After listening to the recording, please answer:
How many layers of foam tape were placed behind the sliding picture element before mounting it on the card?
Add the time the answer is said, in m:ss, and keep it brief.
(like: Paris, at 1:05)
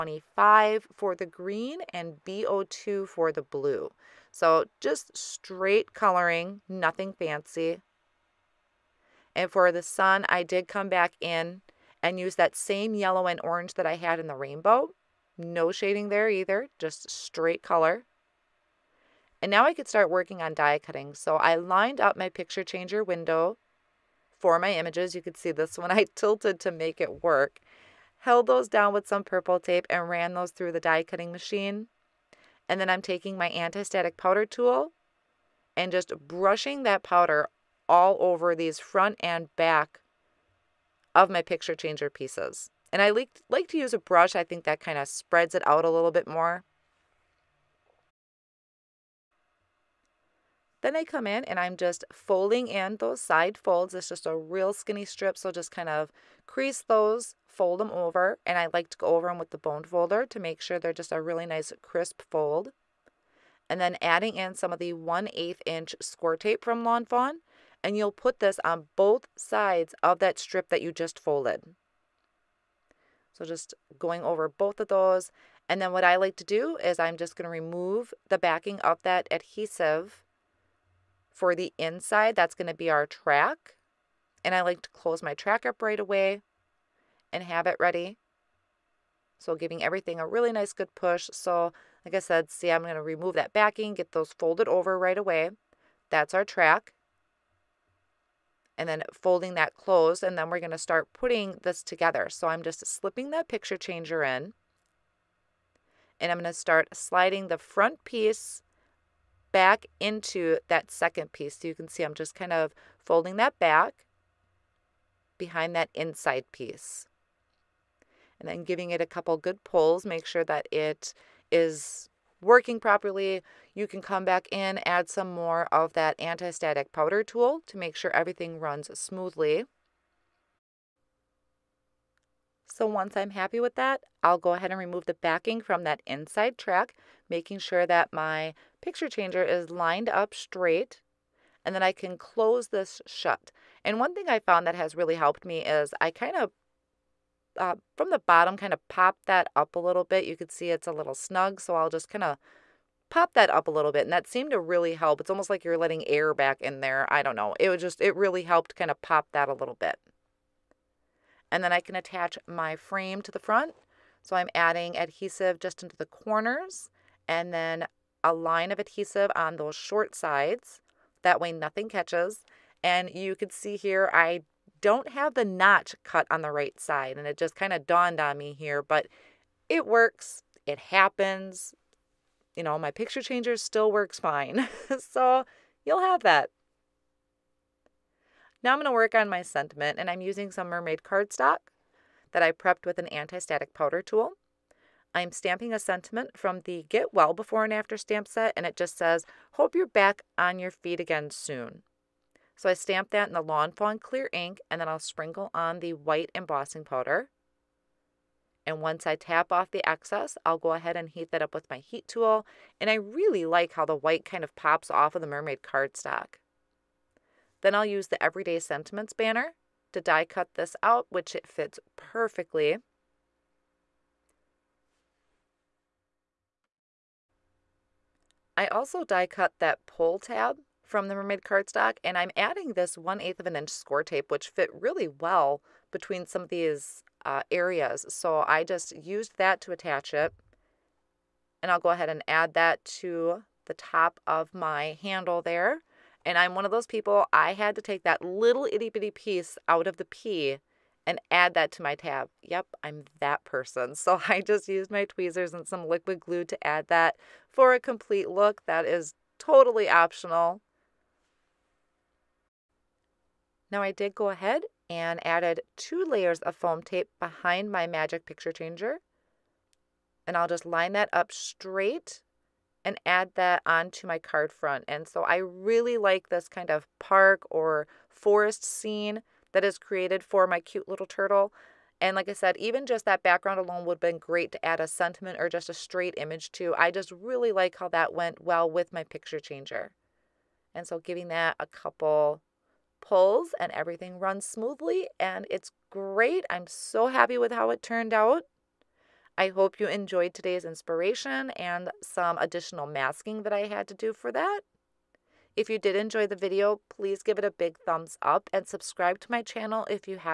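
2, at 4:25.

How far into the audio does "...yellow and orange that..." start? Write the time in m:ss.
0:12.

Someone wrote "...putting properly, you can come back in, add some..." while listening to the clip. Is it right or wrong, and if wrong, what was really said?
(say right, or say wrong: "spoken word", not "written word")
wrong: "working", not "putting".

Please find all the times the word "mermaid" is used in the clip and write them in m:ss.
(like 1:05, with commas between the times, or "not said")
3:10, 3:35, 3:51.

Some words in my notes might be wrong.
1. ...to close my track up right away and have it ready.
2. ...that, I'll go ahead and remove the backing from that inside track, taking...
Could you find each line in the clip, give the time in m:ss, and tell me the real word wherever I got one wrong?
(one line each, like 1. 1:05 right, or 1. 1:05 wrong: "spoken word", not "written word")
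1. 1:24 right
2. 2:13 wrong: "making", not "taking".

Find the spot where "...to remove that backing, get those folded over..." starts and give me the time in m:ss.
1:32.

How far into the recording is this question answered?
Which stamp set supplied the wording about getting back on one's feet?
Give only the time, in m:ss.
3:16.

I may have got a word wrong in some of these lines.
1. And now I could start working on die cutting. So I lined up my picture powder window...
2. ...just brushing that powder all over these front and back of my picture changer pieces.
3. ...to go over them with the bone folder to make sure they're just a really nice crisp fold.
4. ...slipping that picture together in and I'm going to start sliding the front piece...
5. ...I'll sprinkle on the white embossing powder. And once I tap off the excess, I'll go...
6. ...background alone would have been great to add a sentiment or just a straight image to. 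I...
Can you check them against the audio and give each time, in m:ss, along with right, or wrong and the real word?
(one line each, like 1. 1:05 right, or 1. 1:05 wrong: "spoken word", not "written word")
1. 0:19 wrong: "changer", not "powder"
2. 0:35 right
3. 0:58 right
4. 1:42 wrong: "changer", not "together"
5. 3:24 right
6. 4:43 right.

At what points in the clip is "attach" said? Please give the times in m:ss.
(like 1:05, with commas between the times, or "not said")
2:41, 3:59.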